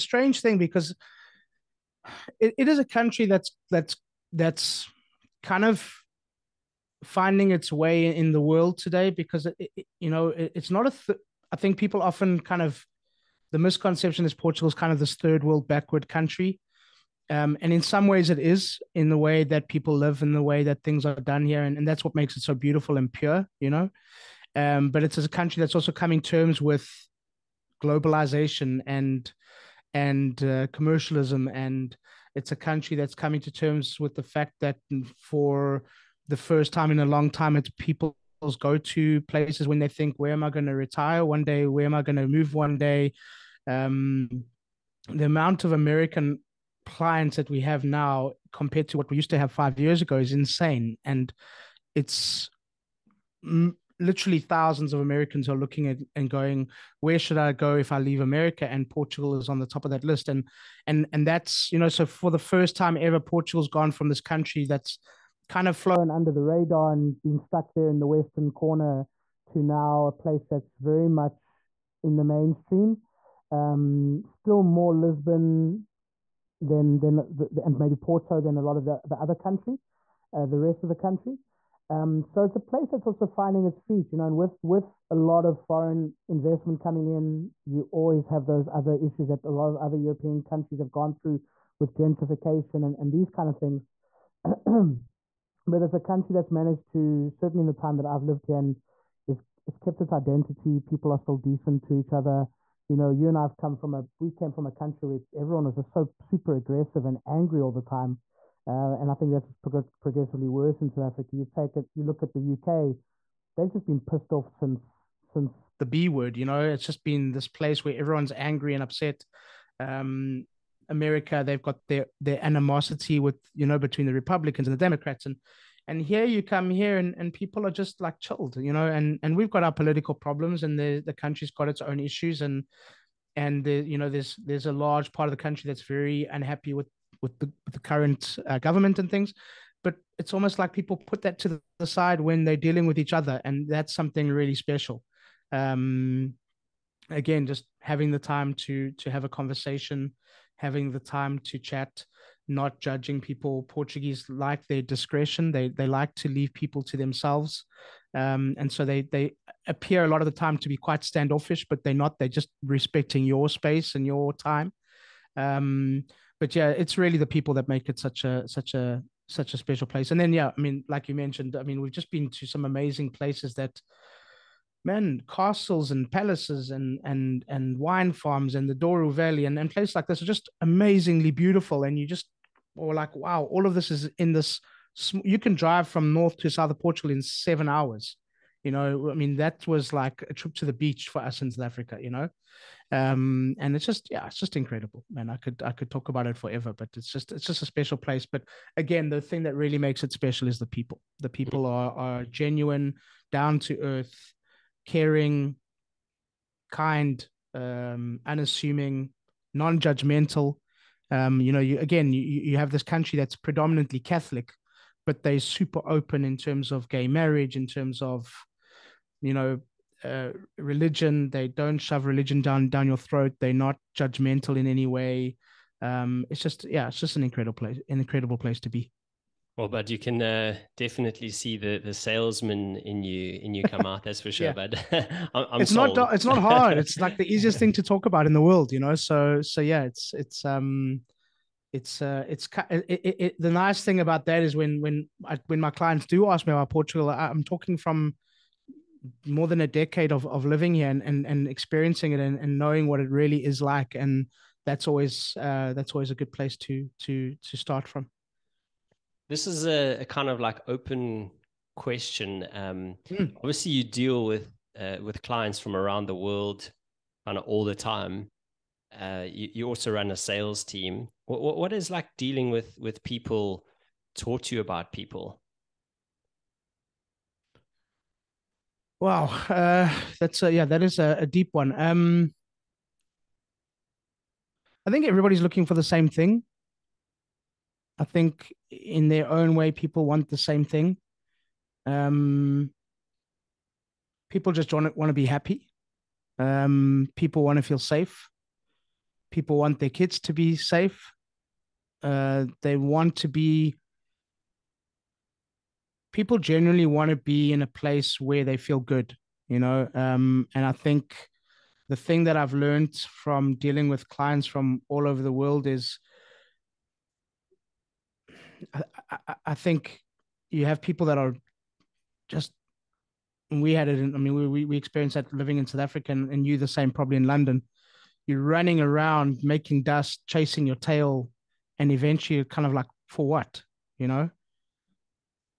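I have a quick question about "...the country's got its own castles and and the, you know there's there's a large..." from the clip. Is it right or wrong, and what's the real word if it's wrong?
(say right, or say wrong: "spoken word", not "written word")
wrong: "issues", not "castles".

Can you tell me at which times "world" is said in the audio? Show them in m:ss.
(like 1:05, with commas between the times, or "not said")
0:08, 0:15, 3:58, 4:26, 5:15.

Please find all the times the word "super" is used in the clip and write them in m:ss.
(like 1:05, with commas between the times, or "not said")
1:46, 3:35.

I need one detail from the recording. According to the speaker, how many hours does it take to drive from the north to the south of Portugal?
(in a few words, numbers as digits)
7.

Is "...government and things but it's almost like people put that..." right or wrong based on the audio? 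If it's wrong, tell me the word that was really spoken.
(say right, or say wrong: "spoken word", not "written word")
right.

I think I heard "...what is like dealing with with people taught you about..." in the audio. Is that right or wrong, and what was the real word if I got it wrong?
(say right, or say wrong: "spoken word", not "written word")
right.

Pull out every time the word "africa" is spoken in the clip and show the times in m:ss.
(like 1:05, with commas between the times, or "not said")
1:51, 3:11, 5:25.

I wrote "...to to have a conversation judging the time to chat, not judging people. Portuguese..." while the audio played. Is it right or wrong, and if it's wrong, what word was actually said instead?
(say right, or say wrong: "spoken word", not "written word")
wrong: "having", not "judging".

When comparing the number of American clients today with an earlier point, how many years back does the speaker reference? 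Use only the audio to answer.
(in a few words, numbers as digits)
5.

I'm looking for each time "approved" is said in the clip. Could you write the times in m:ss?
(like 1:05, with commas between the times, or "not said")
not said.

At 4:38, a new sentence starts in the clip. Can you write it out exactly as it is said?
Wow, uh, that's a, yeah, that is a, a deep one.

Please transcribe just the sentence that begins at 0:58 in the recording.
And Portugal is on the top of that list.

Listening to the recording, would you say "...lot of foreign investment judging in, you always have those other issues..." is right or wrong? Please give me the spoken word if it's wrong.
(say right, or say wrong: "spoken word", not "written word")
wrong: "coming", not "judging".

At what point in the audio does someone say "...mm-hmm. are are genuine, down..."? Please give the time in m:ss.
3:21.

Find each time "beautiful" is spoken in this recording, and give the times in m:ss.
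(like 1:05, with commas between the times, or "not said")
0:22, 3:01.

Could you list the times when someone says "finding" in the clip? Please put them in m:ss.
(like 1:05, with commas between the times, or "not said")
0:07, 1:23.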